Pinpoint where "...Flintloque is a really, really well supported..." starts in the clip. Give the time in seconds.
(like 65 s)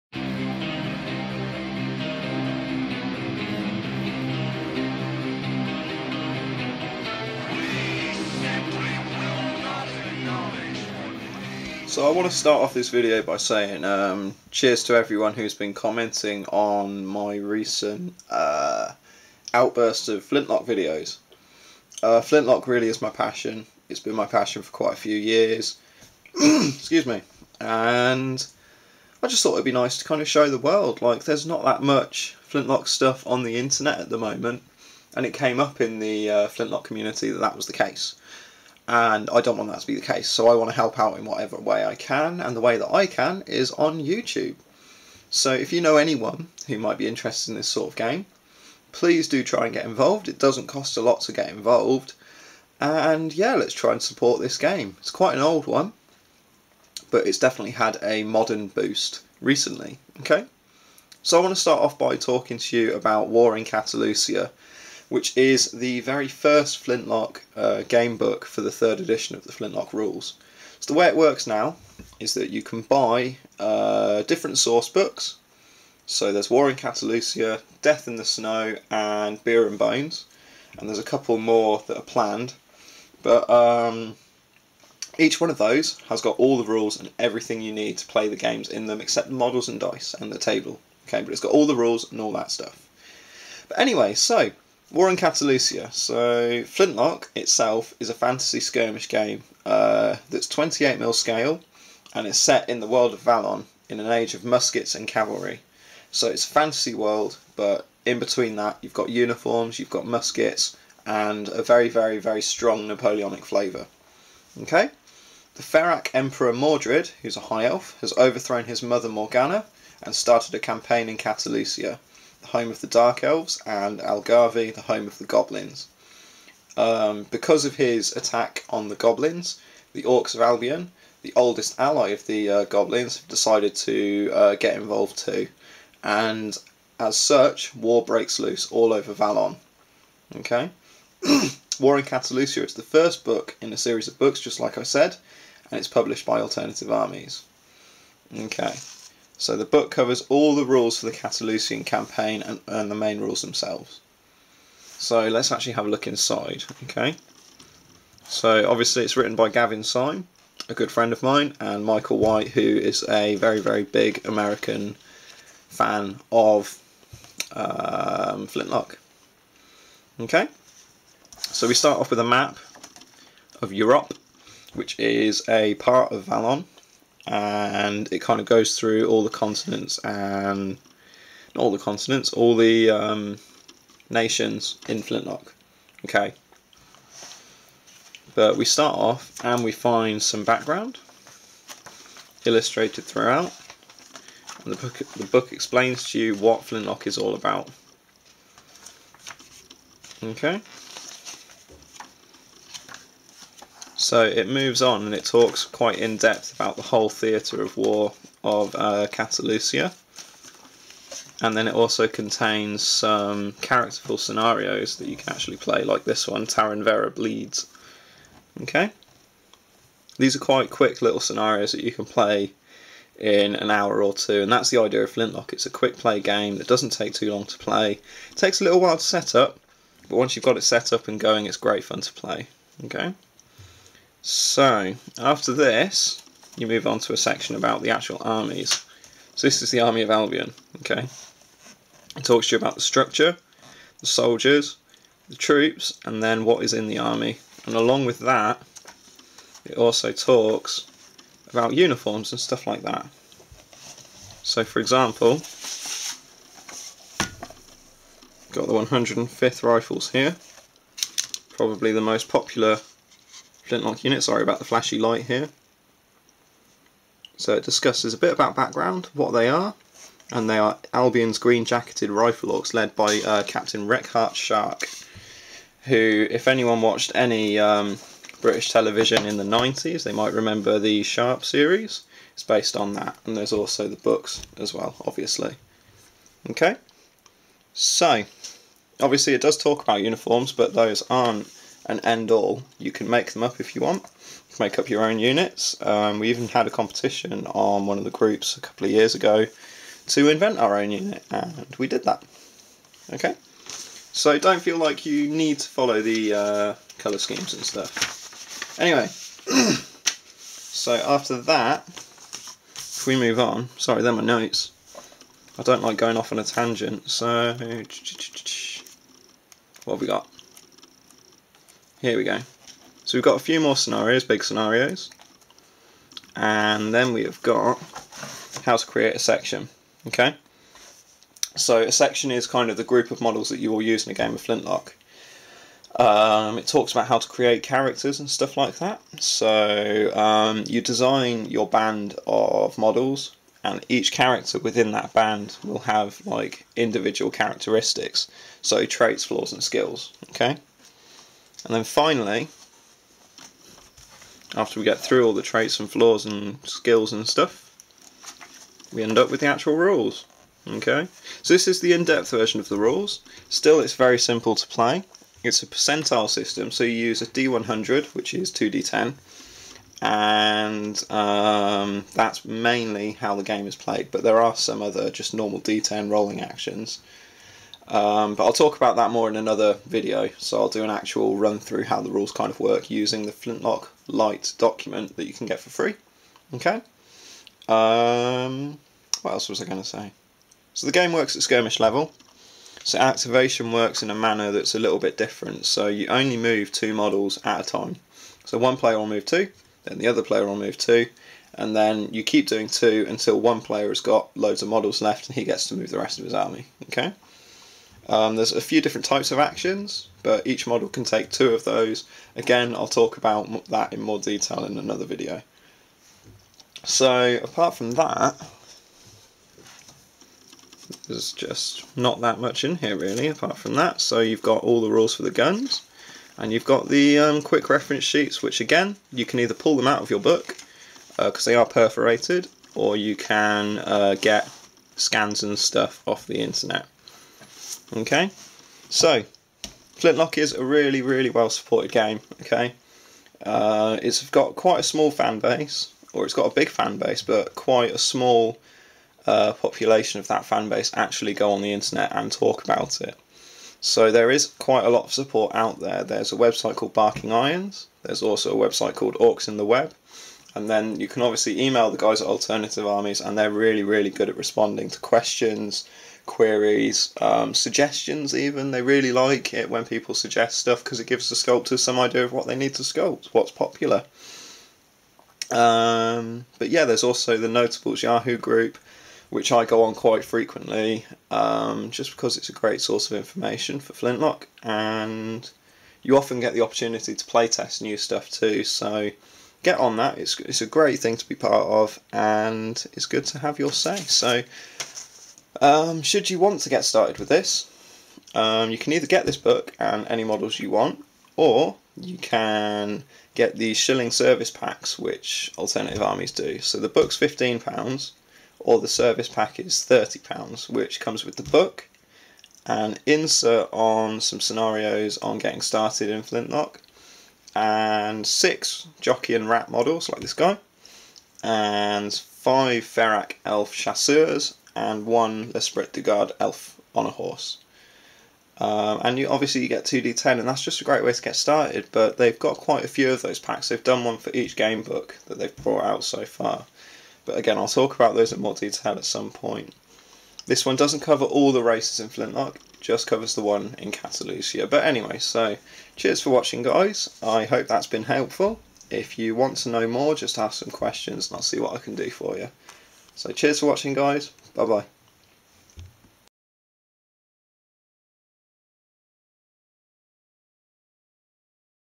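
439 s.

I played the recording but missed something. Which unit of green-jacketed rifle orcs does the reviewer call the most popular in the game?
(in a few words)
105th Rifles.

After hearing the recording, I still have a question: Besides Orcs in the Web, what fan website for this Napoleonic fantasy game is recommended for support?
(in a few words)
Barking Irons.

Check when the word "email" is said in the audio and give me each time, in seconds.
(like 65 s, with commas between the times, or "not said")
461 s.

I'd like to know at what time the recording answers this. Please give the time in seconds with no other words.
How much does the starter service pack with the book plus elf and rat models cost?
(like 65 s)
509 s.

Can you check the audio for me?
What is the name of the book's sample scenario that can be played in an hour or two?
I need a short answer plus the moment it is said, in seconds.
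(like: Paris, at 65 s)
Taran Vera Bleeds, at 216 s.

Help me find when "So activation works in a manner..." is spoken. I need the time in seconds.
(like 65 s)
392 s.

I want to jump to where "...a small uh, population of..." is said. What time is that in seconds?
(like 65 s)
447 s.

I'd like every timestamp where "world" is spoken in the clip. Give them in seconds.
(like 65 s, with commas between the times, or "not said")
30 s, 102 s, 106 s.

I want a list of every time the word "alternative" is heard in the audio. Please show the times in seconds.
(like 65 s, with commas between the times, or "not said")
146 s, 462 s, 505 s.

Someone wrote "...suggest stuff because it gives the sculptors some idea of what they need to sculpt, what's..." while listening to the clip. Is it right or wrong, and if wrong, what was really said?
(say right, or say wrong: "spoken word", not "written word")
right.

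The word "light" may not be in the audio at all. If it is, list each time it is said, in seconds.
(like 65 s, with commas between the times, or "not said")
264 s, 384 s.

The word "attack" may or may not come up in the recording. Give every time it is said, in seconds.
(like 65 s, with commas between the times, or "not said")
128 s.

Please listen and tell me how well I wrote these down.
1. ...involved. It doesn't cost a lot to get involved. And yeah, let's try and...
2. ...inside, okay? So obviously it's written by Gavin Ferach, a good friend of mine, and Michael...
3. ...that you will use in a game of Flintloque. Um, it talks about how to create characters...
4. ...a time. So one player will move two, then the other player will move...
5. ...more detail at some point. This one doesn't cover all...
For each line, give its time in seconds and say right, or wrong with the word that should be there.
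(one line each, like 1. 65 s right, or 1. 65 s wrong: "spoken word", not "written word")
1. 49 s right
2. 156 s wrong: "Syme", not "Ferach"
3. 333 s right
4. 397 s right
5. 538 s right.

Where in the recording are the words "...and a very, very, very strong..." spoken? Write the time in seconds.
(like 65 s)
111 s.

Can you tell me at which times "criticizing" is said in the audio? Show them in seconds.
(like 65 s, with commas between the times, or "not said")
not said.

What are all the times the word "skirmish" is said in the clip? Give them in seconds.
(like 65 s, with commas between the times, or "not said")
98 s, 391 s.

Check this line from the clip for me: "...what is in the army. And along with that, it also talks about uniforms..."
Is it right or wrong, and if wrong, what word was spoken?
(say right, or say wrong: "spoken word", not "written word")
right.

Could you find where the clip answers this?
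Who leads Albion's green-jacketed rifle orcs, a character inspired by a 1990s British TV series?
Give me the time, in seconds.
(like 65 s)
273 s.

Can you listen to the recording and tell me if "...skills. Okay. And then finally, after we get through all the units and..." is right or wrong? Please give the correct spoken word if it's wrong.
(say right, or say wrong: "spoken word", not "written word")
wrong: "traits", not "units".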